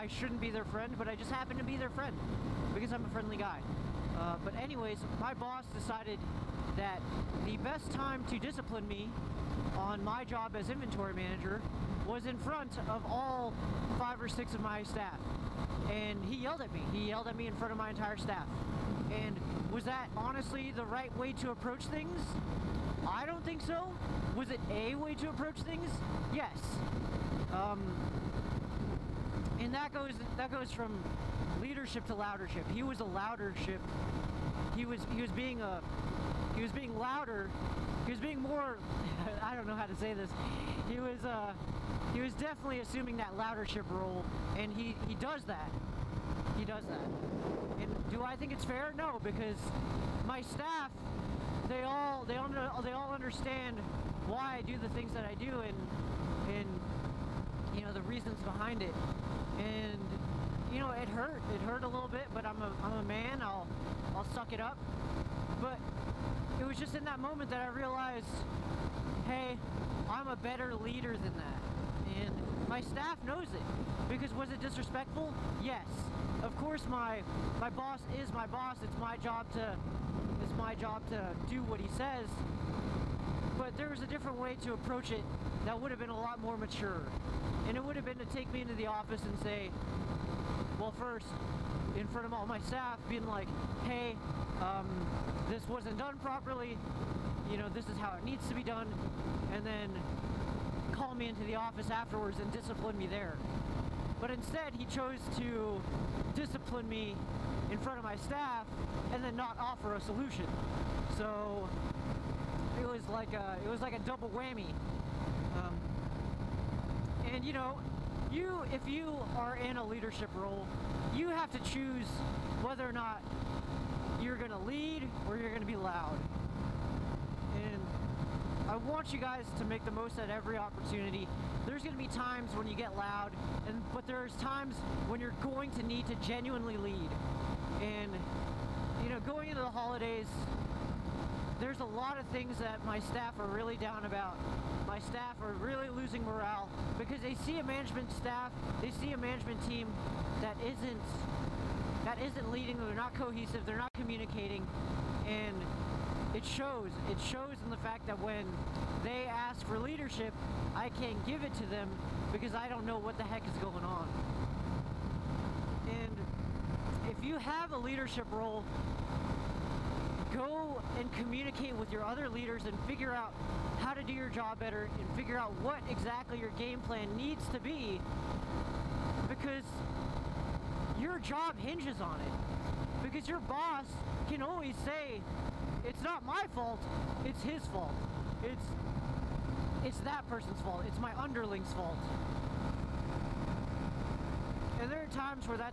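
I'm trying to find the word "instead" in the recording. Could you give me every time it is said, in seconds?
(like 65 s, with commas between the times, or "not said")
104 s.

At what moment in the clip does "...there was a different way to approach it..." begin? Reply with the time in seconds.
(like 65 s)
83 s.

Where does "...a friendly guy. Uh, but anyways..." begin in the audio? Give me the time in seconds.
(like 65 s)
3 s.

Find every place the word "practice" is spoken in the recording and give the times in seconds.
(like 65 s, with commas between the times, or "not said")
not said.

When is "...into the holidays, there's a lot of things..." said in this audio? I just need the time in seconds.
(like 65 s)
139 s.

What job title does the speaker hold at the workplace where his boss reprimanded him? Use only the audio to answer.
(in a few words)
Inventory manager.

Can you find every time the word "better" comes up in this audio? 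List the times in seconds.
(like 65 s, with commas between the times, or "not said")
70 s, 174 s.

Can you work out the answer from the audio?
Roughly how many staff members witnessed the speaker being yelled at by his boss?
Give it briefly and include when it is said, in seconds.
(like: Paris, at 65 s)
5 or 6, at 13 s.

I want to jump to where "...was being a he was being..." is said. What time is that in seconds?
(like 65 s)
35 s.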